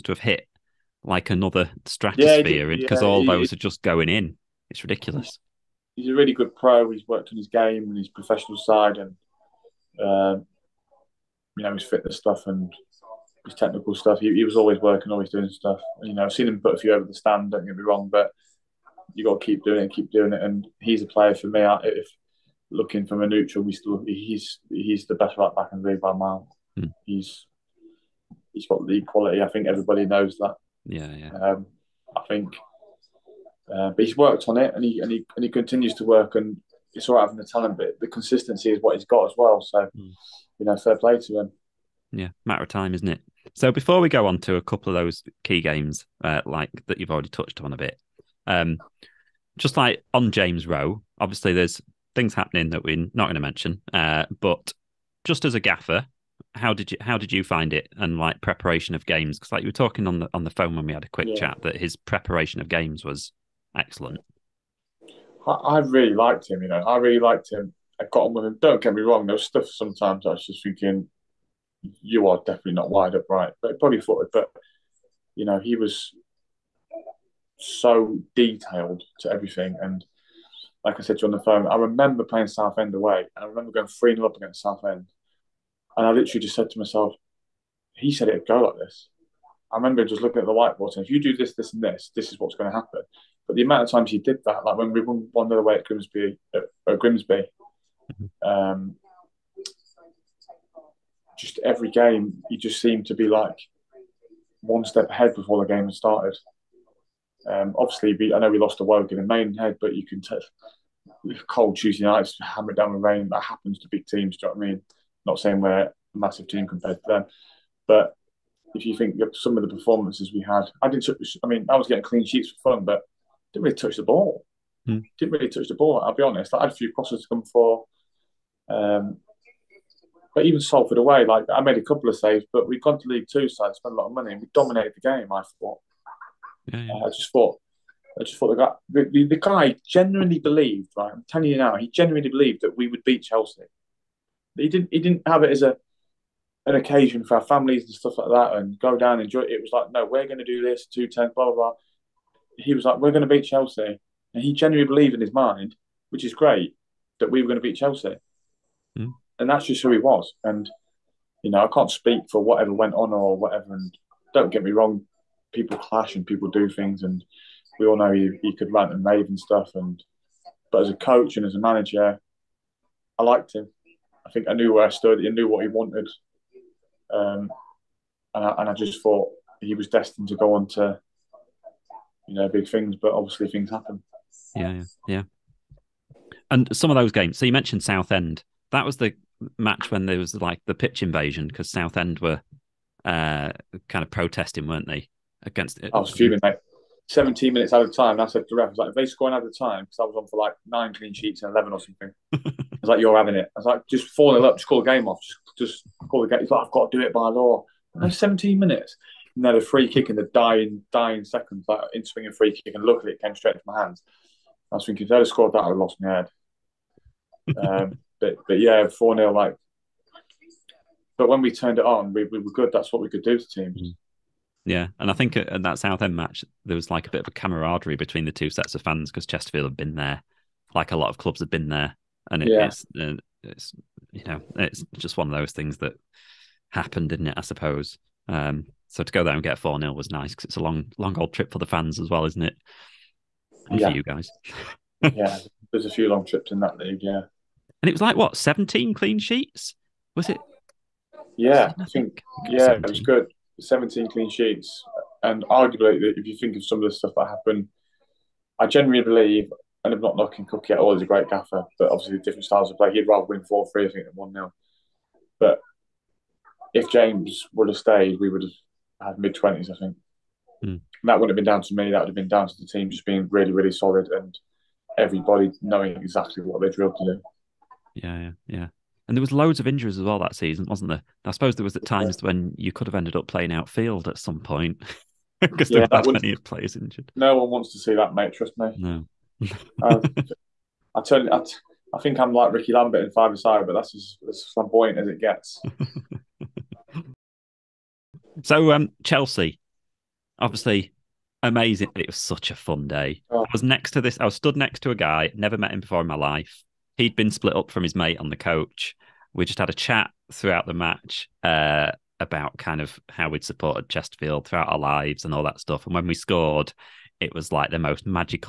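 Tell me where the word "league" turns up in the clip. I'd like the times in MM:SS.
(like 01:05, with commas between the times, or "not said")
00:25, 02:13, 04:06.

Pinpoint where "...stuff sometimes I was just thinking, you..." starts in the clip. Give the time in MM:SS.
01:09.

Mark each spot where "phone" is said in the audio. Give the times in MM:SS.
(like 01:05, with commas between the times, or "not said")
01:00, 01:21.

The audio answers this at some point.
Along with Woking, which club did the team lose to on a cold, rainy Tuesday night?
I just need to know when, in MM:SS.
01:49.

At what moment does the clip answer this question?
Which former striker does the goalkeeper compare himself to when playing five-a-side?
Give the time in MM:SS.
04:52.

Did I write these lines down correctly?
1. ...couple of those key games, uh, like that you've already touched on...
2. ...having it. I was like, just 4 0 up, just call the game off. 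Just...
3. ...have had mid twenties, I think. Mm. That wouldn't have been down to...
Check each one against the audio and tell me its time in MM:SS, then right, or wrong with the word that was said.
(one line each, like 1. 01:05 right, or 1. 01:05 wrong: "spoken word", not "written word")
1. 00:44 right
2. 03:23 right
3. 04:28 right.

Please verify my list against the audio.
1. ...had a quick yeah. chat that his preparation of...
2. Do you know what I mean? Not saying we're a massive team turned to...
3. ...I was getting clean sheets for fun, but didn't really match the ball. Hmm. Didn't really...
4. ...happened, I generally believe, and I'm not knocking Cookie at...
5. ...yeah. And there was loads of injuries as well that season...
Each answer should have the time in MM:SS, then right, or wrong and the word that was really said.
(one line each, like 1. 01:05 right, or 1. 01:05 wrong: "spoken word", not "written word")
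1. 01:00 right
2. 01:54 wrong: "compared", not "turned"
3. 02:01 wrong: "touch", not "match"
4. 04:17 right
5. 04:38 right.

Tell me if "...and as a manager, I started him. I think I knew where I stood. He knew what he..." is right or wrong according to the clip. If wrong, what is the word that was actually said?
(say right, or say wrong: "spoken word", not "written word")
wrong: "liked", not "started".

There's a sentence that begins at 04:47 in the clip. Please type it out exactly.
No one wants to see that, mate.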